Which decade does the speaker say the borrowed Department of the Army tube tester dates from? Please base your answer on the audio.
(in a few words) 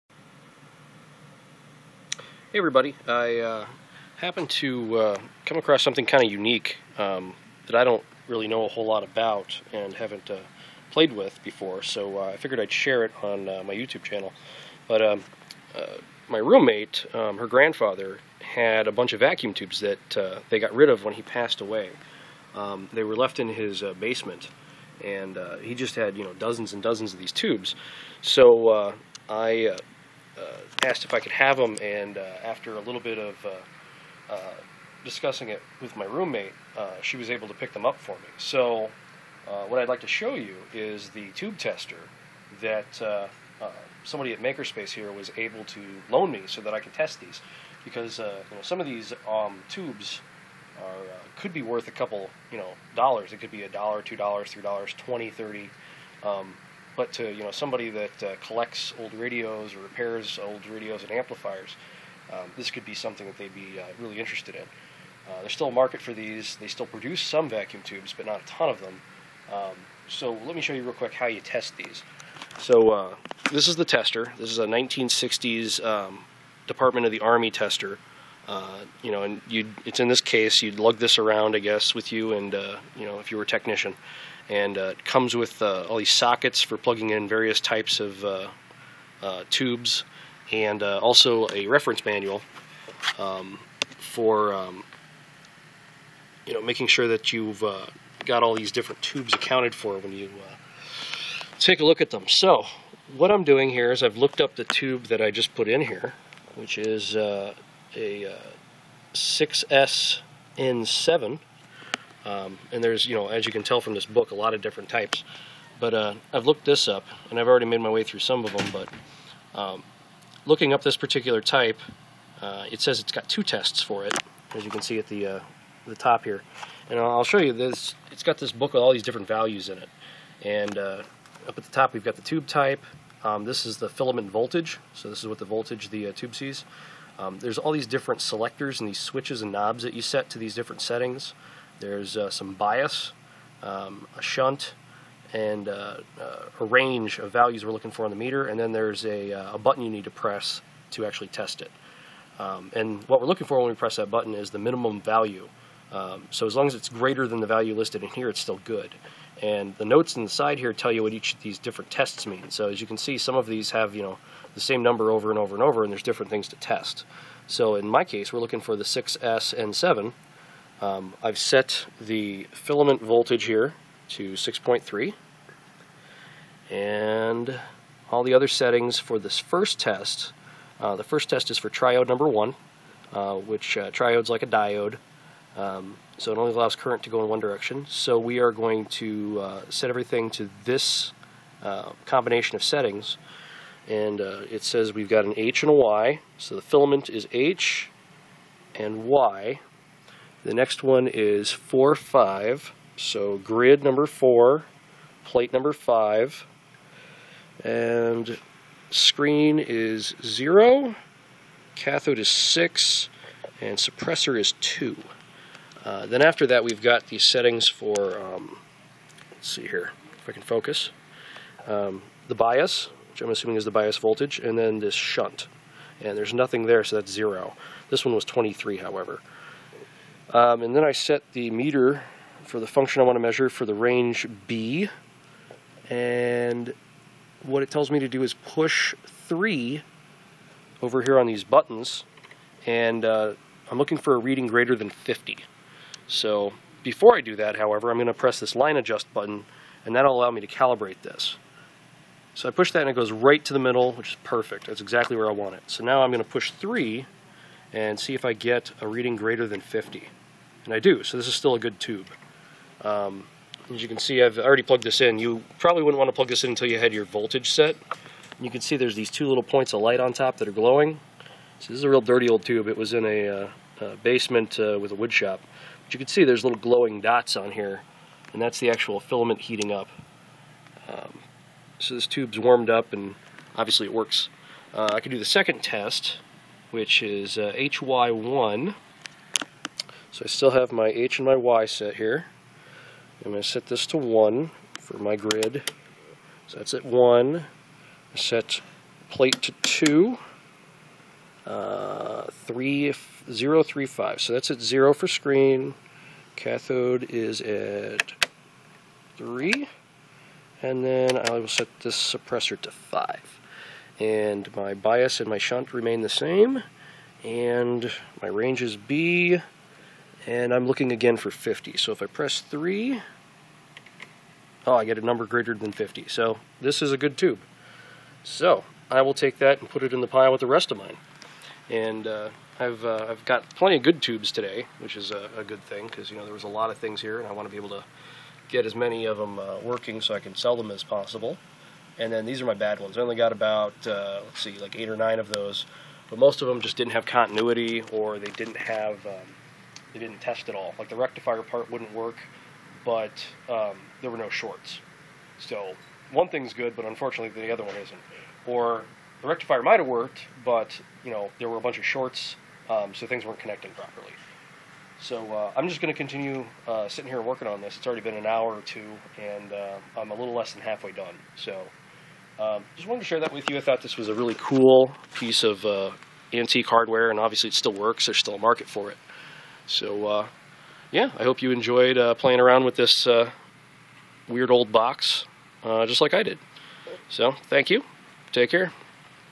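1960s.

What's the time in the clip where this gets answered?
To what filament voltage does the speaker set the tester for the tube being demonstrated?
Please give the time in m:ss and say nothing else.
2:54.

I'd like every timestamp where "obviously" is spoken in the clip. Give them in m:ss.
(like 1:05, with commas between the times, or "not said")
4:43, 6:17.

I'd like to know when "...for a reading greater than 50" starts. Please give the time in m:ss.
4:03.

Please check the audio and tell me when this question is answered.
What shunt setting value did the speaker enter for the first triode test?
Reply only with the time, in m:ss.
3:48.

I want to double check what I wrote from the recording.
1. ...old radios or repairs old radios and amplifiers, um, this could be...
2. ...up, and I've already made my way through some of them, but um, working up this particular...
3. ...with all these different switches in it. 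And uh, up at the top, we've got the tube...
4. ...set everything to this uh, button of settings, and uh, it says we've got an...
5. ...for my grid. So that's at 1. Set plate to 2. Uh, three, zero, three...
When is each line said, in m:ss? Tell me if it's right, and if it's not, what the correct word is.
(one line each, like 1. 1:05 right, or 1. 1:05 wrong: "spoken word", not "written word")
1. 0:58 right
2. 1:56 wrong: "looking", not "working"
3. 2:08 wrong: "values", not "switches"
4. 3:09 wrong: "combination", not "button"
5. 4:54 right.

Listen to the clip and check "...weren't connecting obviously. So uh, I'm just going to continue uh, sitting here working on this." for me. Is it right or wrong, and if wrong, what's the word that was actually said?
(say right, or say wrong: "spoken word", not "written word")
wrong: "properly", not "obviously".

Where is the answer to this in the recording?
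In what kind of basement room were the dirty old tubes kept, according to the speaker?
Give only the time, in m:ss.
4:34.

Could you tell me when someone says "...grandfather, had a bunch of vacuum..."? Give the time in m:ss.
0:17.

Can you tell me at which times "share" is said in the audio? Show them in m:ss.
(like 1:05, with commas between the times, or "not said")
0:12, 6:13.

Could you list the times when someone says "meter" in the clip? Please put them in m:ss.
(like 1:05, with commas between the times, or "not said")
2:28, 3:51.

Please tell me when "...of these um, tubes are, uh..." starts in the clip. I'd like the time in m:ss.
0:48.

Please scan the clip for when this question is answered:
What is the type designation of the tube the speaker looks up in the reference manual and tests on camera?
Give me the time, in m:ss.
1:49.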